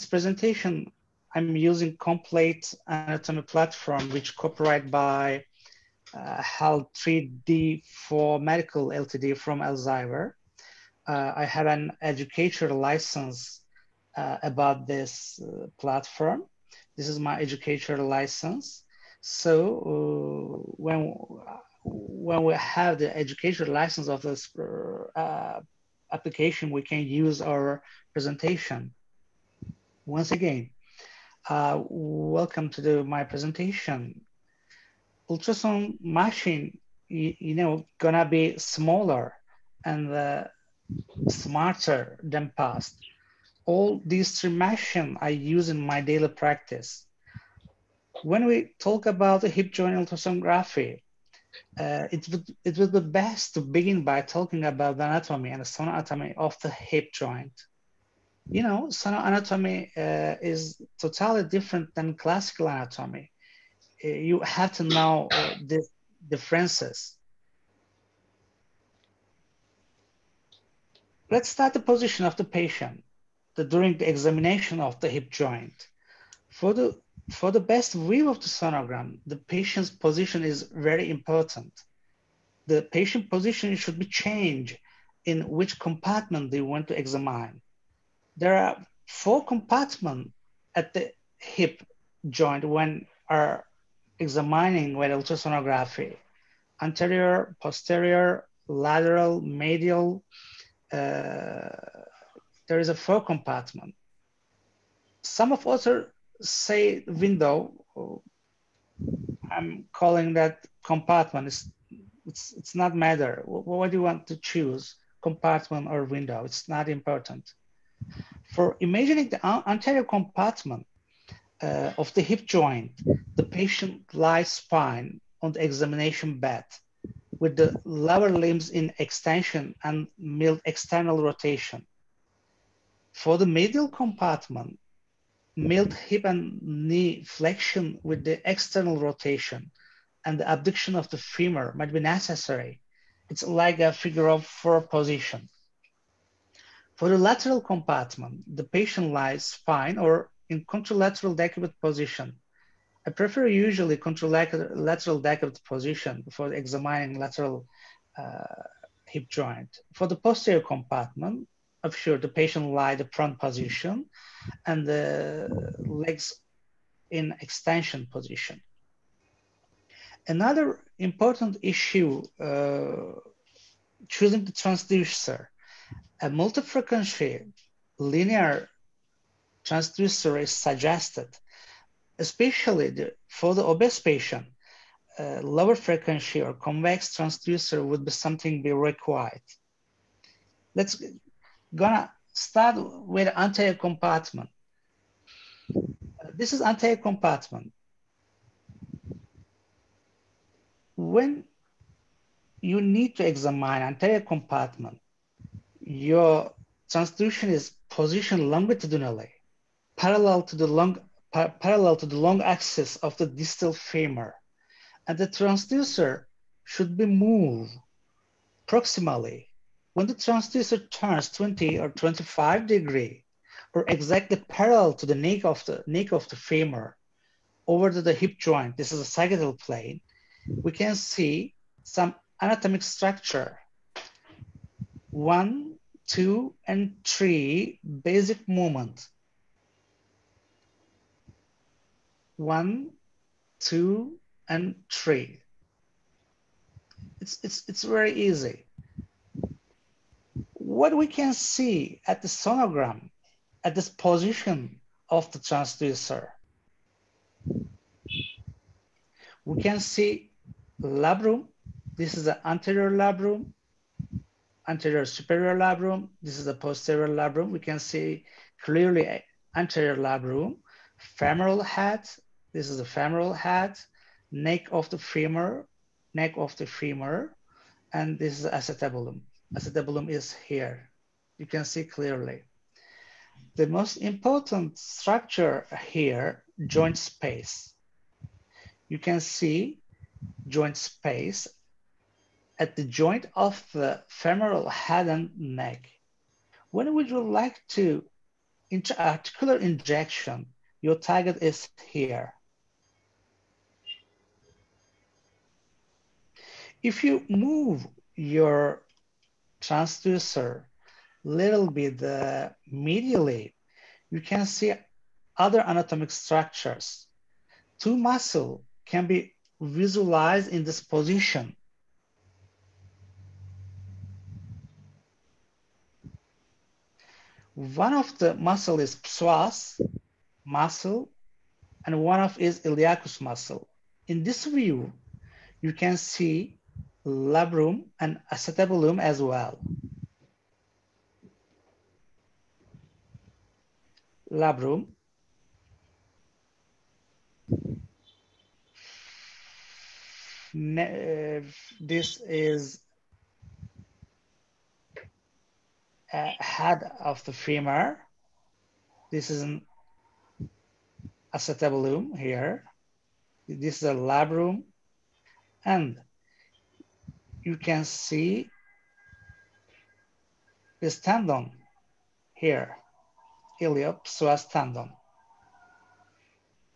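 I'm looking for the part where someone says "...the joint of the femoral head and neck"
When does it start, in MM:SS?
04:52.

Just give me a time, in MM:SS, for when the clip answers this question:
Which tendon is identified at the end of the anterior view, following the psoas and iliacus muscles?
06:13.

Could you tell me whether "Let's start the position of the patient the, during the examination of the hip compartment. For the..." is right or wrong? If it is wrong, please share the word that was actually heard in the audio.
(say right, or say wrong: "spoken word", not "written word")
wrong: "joint", not "compartment".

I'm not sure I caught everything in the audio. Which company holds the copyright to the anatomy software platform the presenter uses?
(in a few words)
HAL 3D for medical LTD.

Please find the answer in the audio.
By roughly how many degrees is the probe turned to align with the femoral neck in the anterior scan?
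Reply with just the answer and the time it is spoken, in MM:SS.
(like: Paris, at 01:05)
20 or 25, at 03:41.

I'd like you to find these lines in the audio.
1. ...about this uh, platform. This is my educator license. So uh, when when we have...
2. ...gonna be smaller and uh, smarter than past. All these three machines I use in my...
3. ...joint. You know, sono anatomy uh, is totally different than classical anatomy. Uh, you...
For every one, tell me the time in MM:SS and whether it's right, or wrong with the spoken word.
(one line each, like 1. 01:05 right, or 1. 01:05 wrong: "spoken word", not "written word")
1. 00:14 right
2. 00:37 right
3. 00:57 right.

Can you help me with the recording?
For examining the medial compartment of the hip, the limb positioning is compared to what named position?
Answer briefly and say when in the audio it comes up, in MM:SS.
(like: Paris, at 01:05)
figure of four, at 02:23.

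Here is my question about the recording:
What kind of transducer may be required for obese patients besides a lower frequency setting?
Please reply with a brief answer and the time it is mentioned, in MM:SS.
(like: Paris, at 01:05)
convex transducer, at 03:06.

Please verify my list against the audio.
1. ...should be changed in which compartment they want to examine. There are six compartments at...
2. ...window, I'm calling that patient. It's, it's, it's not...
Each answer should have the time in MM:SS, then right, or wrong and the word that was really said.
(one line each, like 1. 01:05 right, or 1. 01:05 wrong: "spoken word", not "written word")
1. 01:23 wrong: "four", not "six"
2. 01:47 wrong: "compartment", not "patient".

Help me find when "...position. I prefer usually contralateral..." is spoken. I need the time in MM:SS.
02:31.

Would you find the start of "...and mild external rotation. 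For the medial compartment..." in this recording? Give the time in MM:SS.
02:09.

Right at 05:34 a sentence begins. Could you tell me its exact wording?
In this view, you can see labrum and acetabulum as well.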